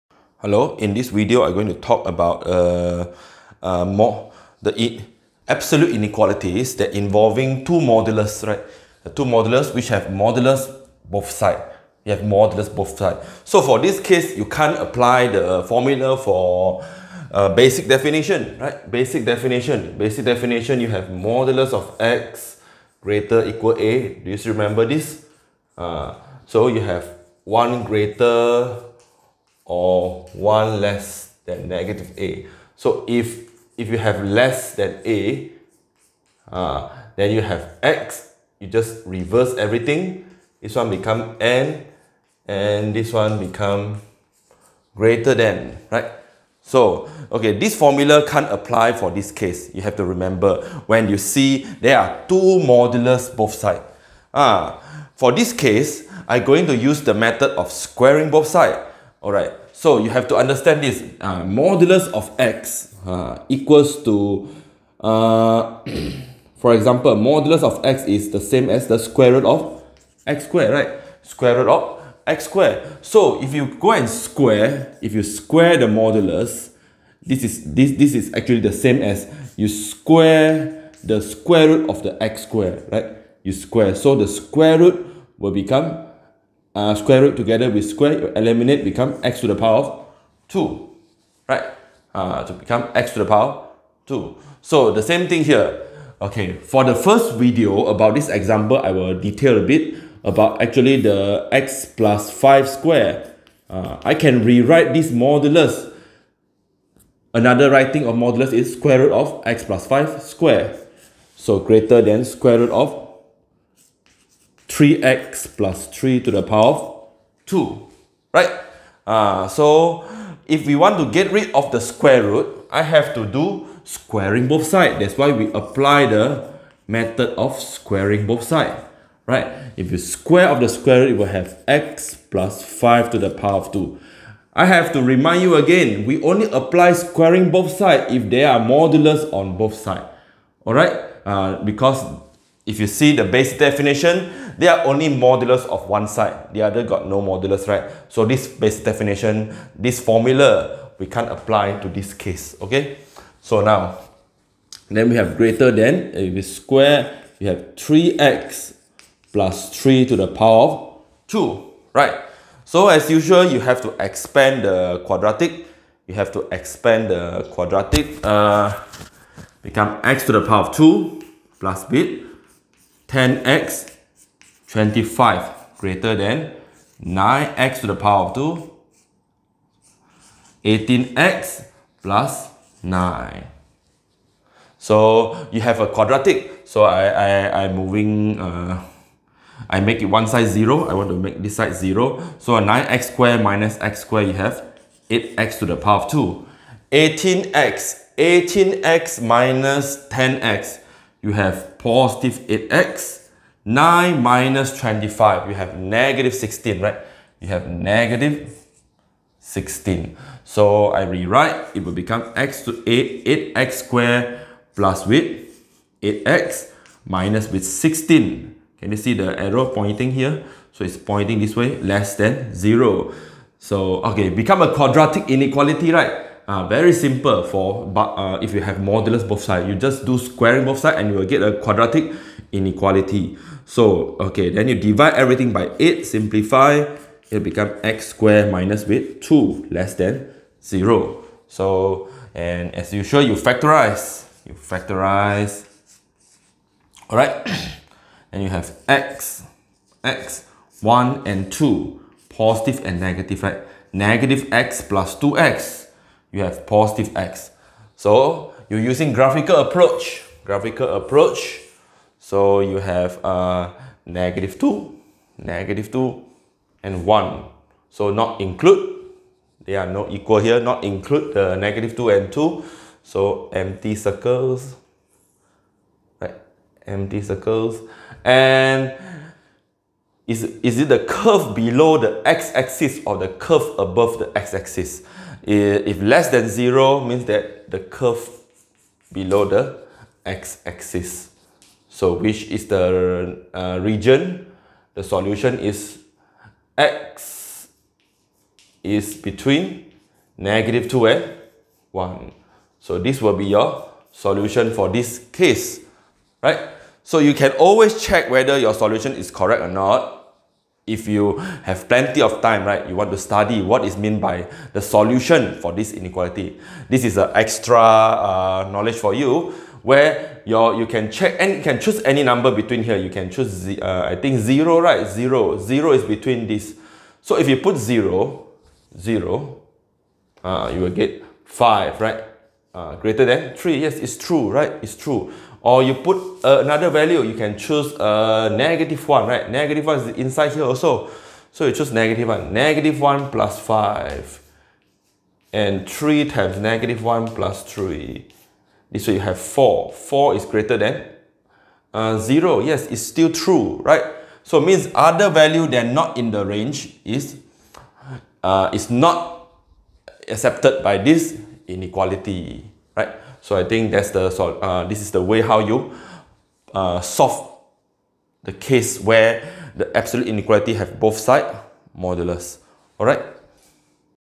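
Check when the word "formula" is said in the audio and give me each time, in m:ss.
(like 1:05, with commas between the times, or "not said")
0:15, 0:47, 2:29.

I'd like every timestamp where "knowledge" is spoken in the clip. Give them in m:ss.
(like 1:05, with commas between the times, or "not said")
5:18.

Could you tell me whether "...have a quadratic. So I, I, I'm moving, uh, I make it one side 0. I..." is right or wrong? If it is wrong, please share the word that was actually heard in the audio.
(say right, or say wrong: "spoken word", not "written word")
right.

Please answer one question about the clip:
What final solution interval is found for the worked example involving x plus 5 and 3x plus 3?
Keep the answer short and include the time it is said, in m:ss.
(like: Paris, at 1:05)
Between -2 and 1, at 4:59.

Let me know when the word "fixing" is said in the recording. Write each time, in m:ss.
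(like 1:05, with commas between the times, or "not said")
not said.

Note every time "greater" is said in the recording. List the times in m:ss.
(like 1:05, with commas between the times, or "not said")
0:22, 0:27, 0:44, 1:51, 2:35, 2:55, 5:32, 5:50.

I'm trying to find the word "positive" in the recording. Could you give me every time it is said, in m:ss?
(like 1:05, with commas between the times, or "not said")
3:21, 4:12, 4:16.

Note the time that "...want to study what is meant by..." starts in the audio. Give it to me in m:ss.
5:12.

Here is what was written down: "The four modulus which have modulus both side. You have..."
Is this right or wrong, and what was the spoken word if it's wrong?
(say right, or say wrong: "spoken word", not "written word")
wrong: "two", not "four".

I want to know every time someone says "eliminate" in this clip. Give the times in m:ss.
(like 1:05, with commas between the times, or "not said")
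1:28.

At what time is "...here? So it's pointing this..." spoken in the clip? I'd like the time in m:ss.
3:40.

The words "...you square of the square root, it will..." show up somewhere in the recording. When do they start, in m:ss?
2:09.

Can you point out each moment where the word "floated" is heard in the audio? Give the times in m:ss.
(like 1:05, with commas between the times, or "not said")
not said.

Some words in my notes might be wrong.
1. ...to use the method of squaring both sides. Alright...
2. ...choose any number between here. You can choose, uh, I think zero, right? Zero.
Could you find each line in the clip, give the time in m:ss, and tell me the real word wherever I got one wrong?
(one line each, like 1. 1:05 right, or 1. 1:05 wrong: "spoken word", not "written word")
1. 0:56 right
2. 5:21 right.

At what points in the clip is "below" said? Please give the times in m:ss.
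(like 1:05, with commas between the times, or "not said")
4:41, 4:49.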